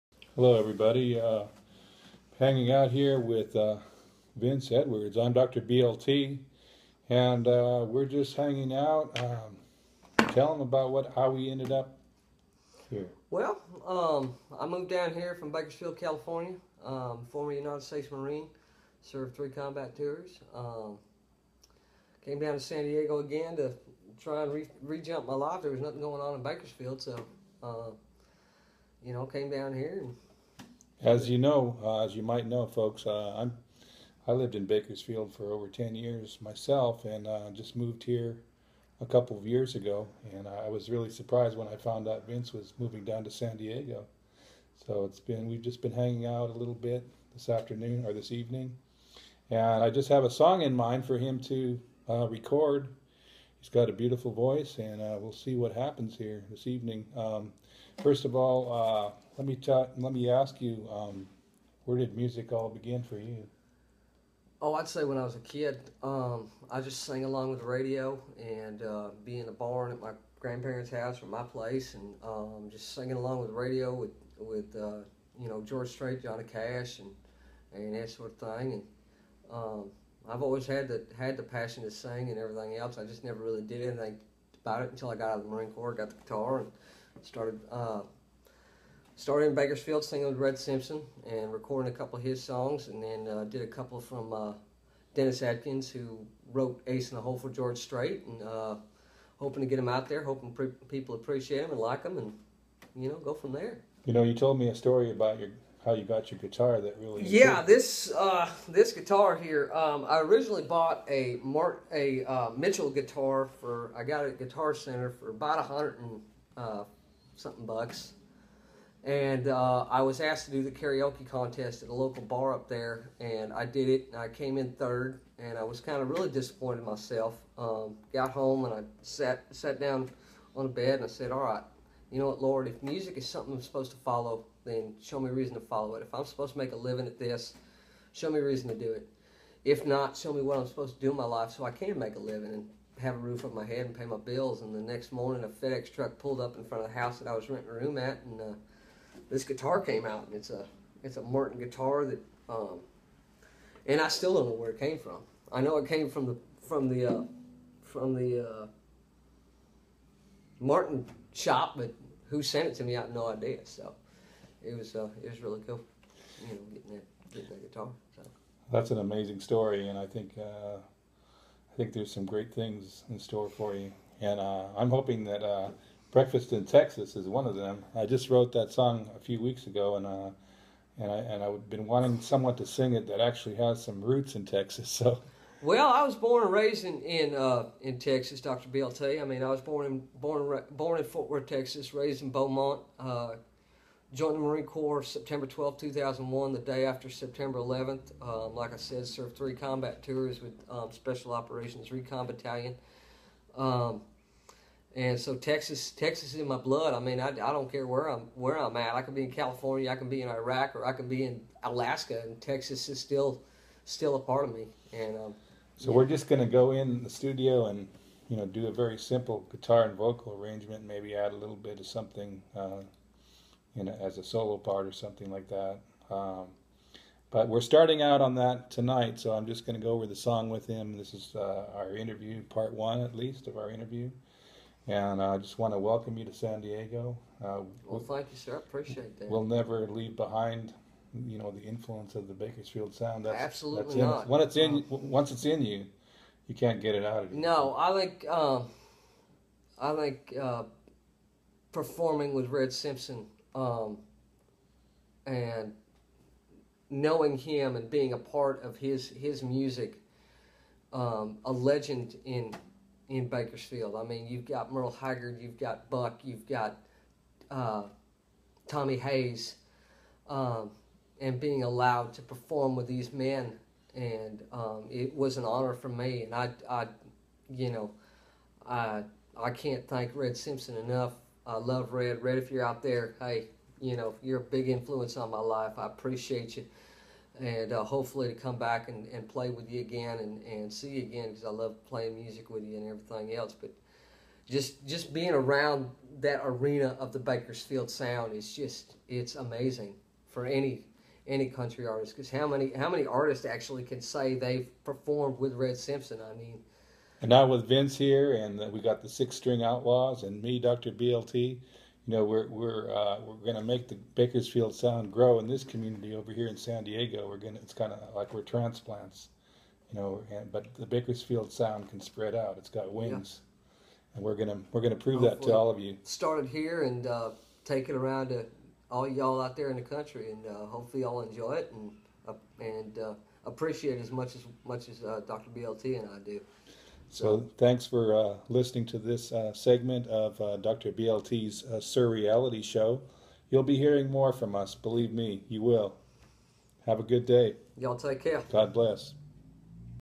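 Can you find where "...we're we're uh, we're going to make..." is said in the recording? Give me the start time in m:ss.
5:12.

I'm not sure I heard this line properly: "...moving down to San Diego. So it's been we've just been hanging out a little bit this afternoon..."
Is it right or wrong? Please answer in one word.
right.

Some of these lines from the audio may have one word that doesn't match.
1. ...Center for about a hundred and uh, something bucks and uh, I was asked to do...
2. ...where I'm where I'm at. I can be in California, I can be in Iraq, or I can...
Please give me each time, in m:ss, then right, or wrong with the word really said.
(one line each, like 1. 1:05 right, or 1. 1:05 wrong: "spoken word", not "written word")
1. 1:54 right
2. 3:27 right.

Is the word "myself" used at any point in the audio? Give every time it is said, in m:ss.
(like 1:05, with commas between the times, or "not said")
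0:36, 2:06.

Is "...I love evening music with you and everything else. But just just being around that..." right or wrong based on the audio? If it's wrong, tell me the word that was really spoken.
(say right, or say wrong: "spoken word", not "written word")
wrong: "playing", not "evening".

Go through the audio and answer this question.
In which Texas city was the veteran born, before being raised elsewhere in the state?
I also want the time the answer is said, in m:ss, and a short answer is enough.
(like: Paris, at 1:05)
Fort Worth, at 3:11.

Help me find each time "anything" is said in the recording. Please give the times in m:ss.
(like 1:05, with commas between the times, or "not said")
1:23.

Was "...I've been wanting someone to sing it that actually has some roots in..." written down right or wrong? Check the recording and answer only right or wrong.
right.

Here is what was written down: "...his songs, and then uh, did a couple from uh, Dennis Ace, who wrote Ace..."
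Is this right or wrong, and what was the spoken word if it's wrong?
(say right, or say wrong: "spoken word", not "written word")
wrong: "Adkins", not "Ace".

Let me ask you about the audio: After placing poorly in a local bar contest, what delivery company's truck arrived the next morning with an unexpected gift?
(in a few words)
FedEx.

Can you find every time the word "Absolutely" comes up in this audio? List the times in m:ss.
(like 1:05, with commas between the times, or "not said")
4:03.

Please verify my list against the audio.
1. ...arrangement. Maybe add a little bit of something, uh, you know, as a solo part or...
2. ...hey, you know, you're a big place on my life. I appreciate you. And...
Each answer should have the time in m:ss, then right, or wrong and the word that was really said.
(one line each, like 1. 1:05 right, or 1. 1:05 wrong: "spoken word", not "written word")
1. 3:40 right
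2. 4:43 wrong: "influence", not "place".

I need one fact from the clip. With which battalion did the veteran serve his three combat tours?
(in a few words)
Special Operations Recon Battalion.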